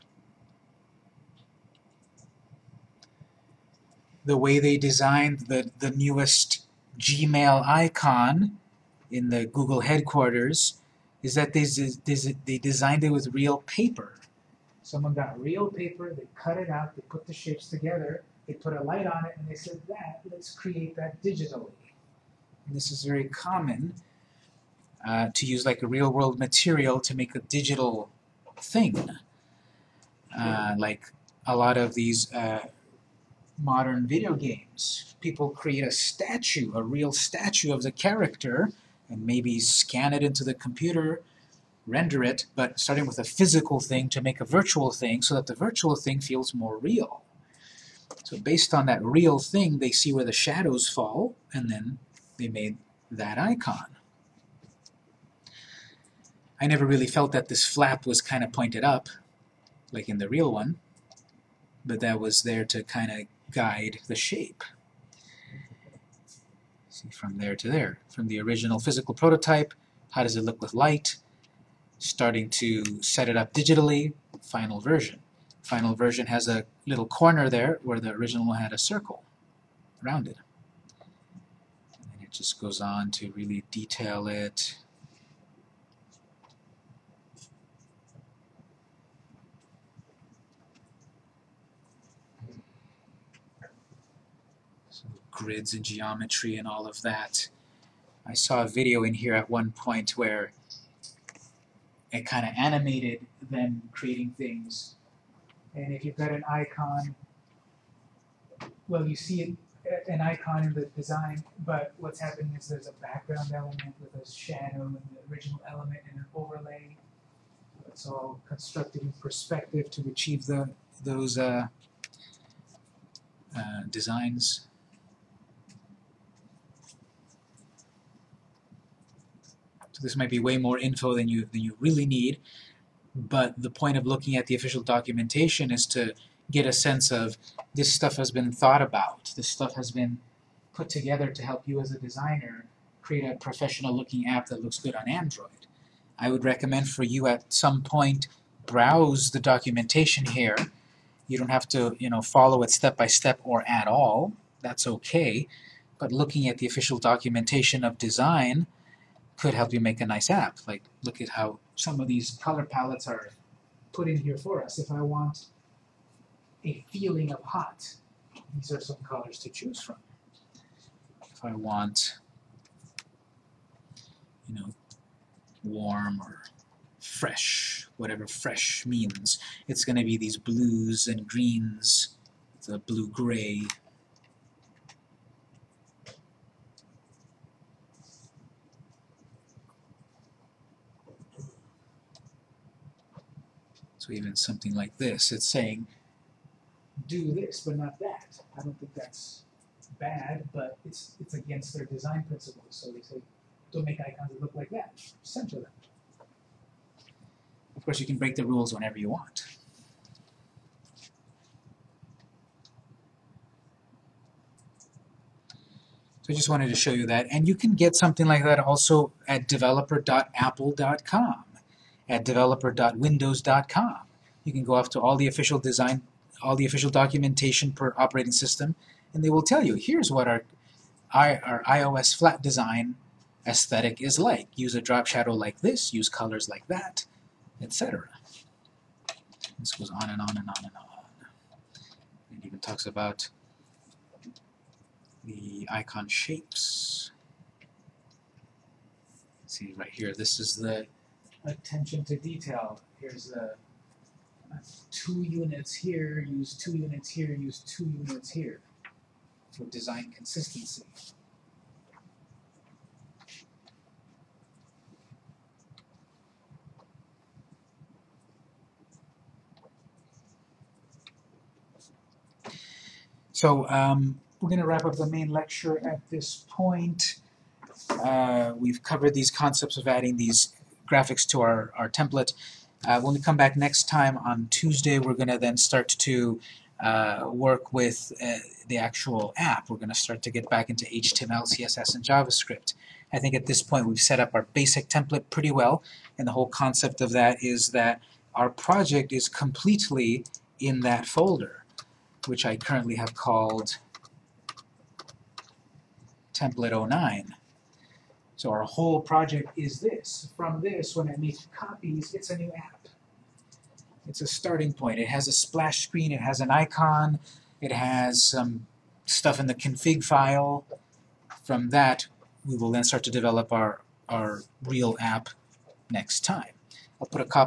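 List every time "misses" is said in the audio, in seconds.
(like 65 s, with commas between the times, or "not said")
not said.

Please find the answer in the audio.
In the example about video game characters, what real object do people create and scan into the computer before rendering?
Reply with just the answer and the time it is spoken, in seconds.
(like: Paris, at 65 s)
a statue, at 36 s.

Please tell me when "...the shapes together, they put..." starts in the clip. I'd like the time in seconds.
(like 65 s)
17 s.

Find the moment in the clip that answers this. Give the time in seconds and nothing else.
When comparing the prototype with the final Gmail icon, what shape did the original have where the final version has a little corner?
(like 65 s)
78 s.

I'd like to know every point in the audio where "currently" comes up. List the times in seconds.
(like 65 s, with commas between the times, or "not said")
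302 s.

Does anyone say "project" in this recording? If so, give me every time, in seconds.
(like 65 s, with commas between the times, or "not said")
298 s, 309 s.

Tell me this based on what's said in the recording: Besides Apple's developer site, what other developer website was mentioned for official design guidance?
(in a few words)
developer.windows.com.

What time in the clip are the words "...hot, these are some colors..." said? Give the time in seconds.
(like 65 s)
167 s.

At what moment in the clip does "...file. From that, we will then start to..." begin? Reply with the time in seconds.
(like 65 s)
320 s.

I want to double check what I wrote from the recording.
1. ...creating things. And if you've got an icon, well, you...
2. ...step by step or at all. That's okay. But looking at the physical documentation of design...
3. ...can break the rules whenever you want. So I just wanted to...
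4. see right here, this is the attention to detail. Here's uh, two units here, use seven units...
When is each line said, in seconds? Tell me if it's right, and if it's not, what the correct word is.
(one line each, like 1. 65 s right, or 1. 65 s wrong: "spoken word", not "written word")
1. 103 s right
2. 152 s wrong: "official", not "physical"
3. 208 s right
4. 249 s wrong: "two", not "seven".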